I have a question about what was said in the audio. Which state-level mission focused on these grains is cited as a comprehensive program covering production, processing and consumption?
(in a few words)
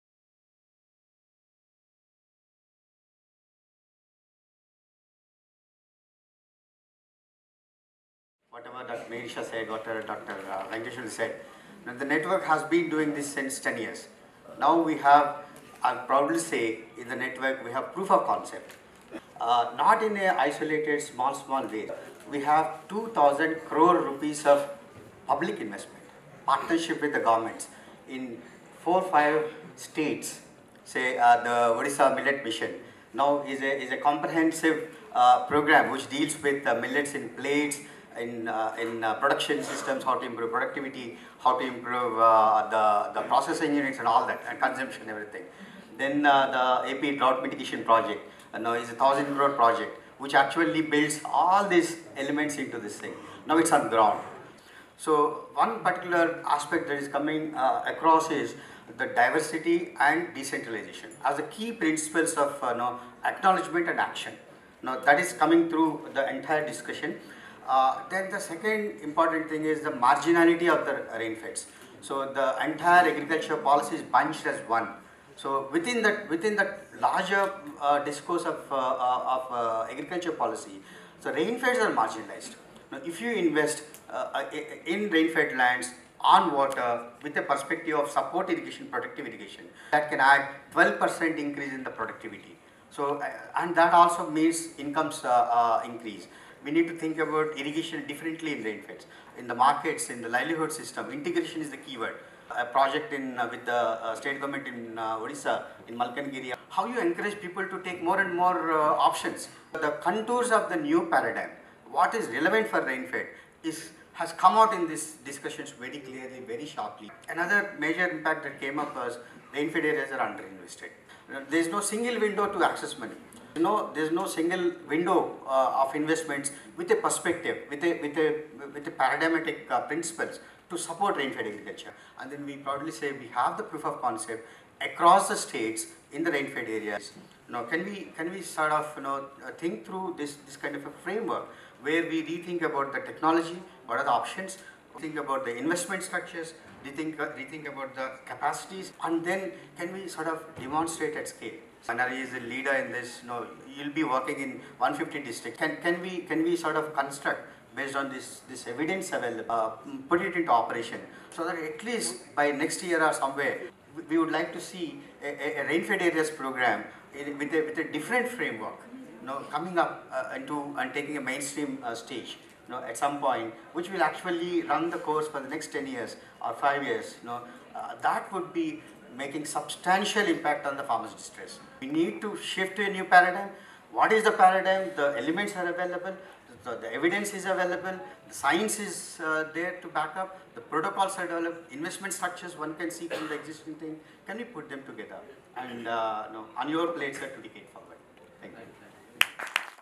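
Odisha Millet Mission.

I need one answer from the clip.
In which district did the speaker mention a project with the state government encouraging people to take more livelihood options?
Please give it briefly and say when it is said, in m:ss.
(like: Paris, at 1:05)
Malkangiri, at 1:46.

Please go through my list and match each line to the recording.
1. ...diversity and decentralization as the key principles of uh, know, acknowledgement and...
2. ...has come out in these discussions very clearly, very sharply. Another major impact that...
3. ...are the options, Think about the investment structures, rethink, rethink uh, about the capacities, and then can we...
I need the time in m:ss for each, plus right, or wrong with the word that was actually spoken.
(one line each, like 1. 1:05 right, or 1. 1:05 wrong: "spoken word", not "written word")
1. 0:59 right
2. 1:54 right
3. 2:23 right.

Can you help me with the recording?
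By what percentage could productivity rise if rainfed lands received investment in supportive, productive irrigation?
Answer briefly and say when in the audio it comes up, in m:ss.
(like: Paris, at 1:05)
12%, at 1:30.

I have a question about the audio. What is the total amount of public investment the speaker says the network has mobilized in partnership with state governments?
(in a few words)
2,000 crore rupees.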